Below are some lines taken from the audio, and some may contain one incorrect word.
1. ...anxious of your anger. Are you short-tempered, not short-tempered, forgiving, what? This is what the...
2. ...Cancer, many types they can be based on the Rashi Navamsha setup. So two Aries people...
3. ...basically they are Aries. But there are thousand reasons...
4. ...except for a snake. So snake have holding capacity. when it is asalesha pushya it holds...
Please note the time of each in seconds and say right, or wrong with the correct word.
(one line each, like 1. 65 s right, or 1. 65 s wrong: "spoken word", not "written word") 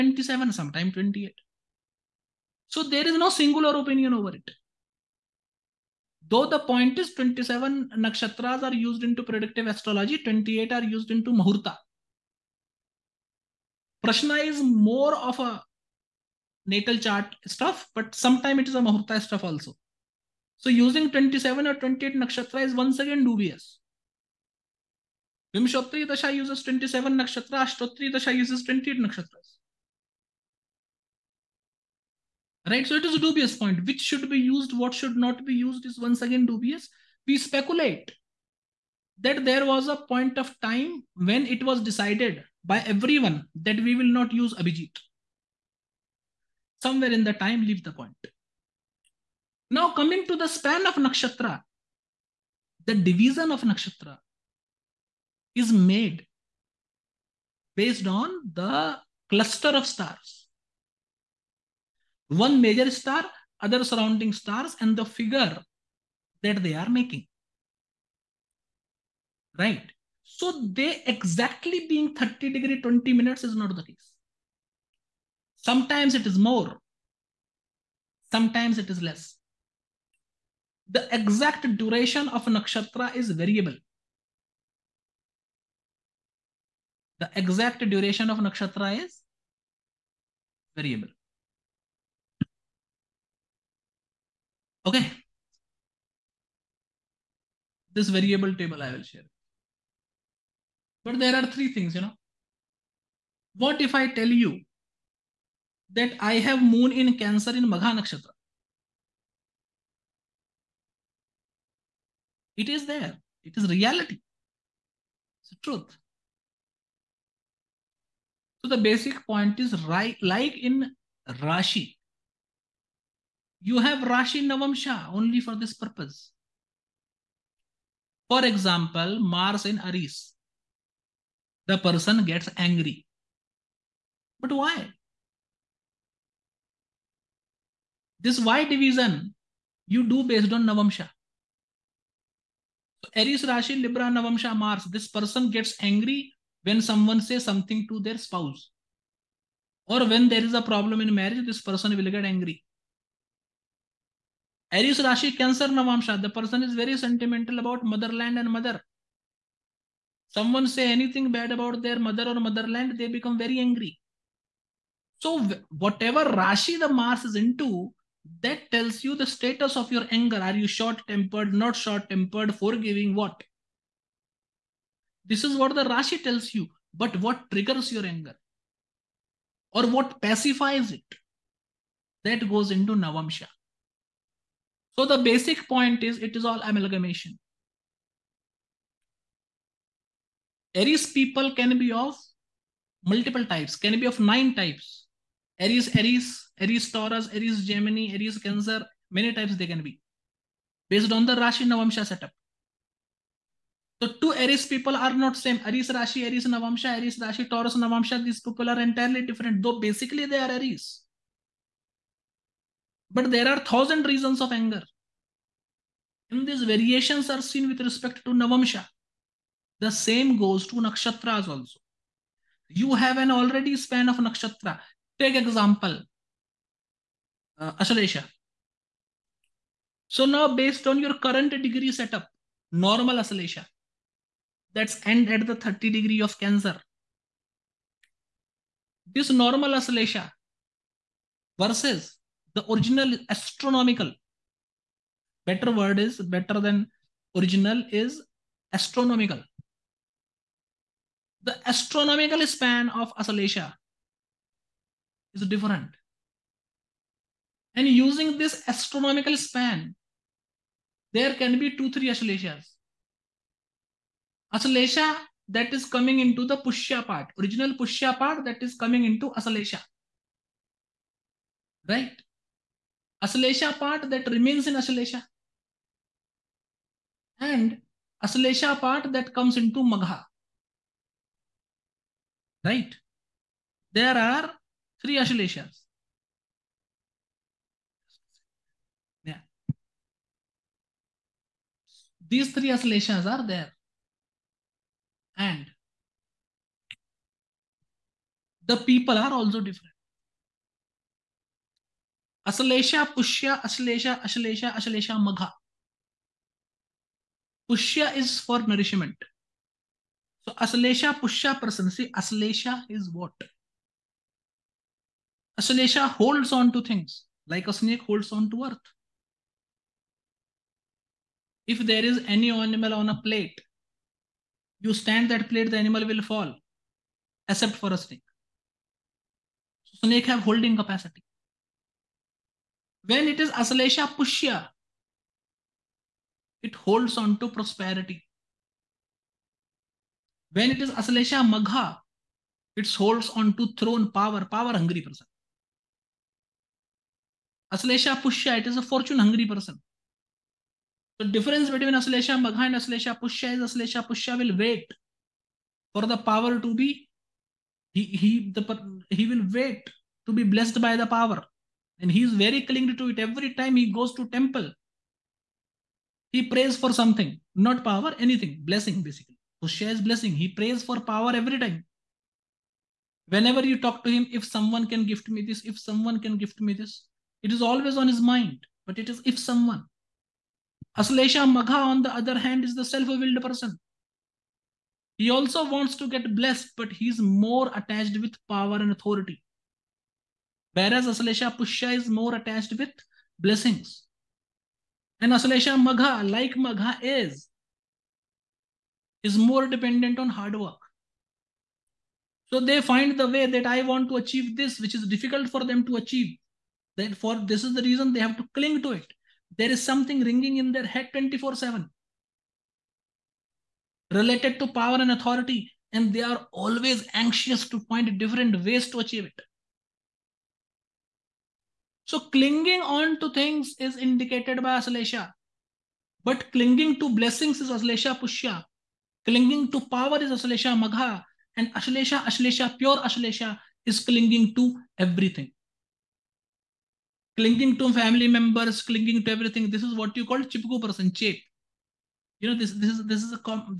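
1. 169 s wrong: "status", not "anxious"
2. 198 s right
3. 209 s right
4. 327 s right.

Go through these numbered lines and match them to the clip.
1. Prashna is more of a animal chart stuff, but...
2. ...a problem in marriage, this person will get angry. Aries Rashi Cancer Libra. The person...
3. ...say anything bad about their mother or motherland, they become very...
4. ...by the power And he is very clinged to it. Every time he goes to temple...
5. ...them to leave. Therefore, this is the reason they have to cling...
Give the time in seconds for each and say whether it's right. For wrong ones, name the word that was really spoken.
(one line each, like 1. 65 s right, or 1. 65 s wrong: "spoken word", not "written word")
1. 14 s wrong: "natal", not "animal"
2. 150 s wrong: "Navamsha", not "Libra"
3. 160 s right
4. 360 s right
5. 405 s wrong: "achieve", not "leave".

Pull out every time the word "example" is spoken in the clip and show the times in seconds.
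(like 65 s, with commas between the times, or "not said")
128 s, 225 s.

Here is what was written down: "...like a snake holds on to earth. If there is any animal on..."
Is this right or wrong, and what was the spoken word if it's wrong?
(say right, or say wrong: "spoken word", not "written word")
right.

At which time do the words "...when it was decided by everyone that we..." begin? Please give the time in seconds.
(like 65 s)
41 s.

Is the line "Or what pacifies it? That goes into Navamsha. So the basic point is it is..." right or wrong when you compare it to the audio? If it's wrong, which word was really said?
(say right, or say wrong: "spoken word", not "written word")
right.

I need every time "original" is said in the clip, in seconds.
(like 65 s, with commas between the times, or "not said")
242 s, 247 s, 267 s.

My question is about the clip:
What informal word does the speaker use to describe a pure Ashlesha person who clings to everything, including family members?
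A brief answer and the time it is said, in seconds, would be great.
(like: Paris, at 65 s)
Chipku, at 440 s.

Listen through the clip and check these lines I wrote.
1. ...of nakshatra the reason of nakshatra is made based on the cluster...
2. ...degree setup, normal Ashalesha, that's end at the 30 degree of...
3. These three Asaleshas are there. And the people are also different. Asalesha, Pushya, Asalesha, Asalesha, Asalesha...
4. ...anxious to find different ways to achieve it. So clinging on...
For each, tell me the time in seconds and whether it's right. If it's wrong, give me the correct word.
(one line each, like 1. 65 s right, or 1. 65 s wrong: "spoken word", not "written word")
1. 50 s wrong: "division", not "reason"
2. 231 s right
3. 292 s right
4. 417 s right.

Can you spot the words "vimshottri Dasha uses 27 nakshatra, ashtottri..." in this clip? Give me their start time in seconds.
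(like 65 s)
25 s.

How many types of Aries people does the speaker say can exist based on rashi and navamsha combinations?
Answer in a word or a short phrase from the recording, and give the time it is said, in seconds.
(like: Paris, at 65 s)
9, at 194 s.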